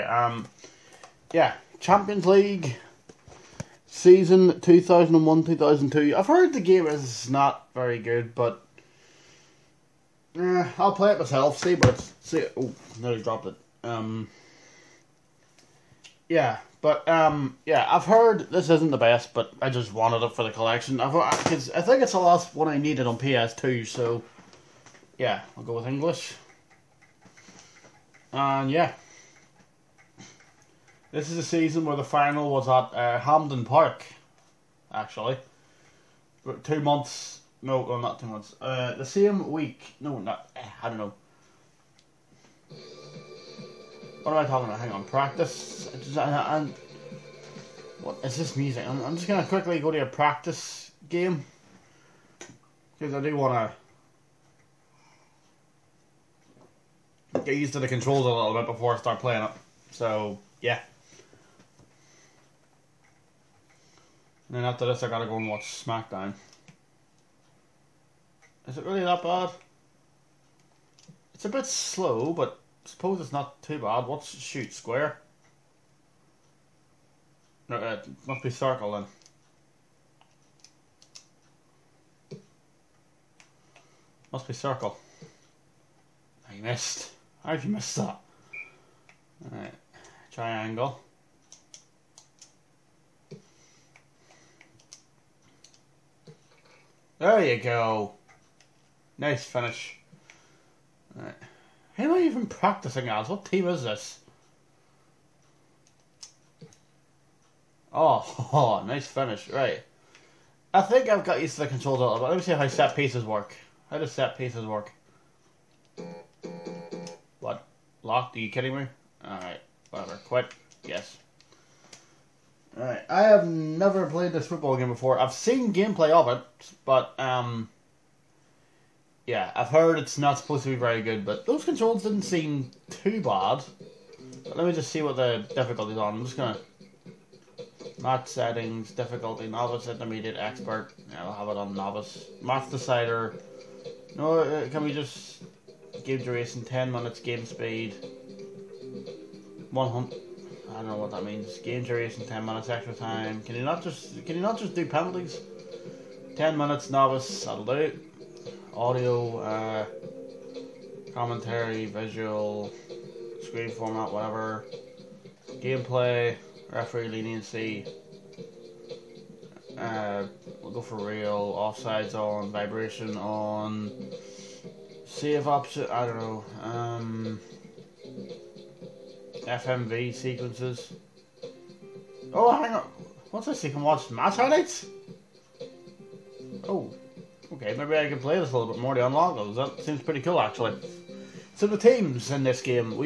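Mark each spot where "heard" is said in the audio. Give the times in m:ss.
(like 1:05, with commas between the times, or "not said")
0:06, 0:18, 2:09.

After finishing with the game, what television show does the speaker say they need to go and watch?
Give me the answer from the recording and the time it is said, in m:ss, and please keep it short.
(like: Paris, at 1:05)
SmackDown, at 1:05.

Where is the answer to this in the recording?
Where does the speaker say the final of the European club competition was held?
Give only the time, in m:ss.
0:33.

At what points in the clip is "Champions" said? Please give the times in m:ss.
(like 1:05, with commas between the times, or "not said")
0:01.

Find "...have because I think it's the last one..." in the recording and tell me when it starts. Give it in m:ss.
0:21.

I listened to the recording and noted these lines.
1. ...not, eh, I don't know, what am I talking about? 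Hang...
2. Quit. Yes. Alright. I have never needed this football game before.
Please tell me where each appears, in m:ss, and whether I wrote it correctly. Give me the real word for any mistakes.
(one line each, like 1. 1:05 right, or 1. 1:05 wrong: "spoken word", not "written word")
1. 0:40 right
2. 2:00 wrong: "played", not "needed".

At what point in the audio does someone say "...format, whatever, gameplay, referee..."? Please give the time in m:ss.
2:43.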